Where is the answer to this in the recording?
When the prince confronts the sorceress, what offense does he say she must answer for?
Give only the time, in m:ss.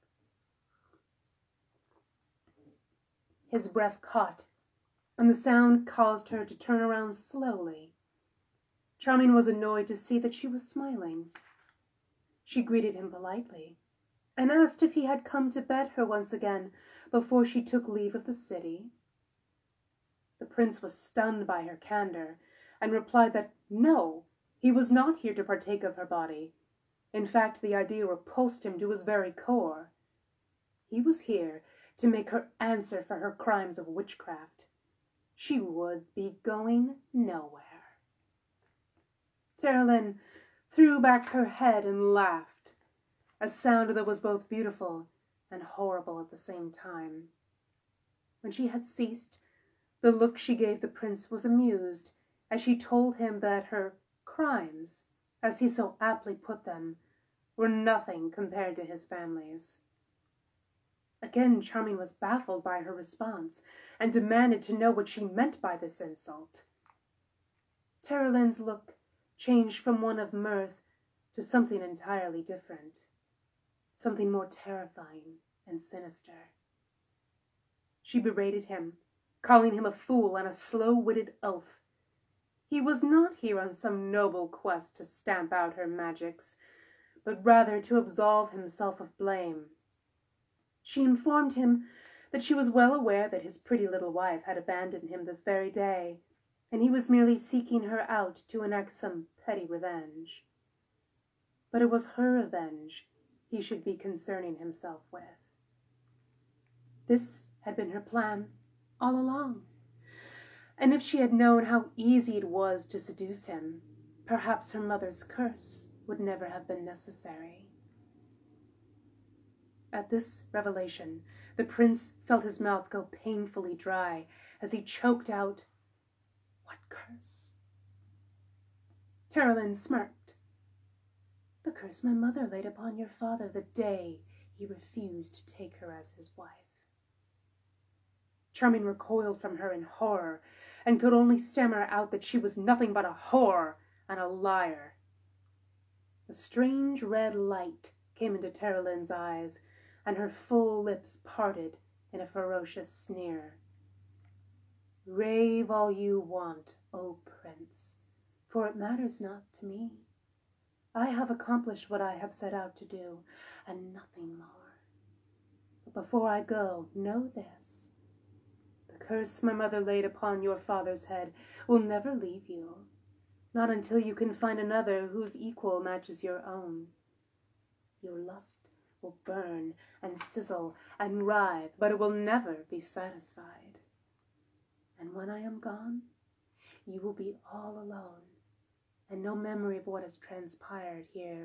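0:33.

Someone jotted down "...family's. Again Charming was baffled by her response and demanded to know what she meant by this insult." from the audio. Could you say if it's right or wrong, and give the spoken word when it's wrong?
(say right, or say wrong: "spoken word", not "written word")
right.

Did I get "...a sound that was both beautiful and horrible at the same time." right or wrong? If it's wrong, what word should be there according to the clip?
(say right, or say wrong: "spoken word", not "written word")
right.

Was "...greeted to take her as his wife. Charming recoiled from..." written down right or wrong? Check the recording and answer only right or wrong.
wrong.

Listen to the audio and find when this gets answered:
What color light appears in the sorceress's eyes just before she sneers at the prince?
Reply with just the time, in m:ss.
2:27.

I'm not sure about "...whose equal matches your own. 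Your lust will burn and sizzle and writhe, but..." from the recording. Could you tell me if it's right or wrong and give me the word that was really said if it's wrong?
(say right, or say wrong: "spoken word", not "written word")
right.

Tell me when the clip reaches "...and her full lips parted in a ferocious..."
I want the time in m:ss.
2:30.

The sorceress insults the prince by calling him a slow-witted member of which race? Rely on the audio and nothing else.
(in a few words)
Elf.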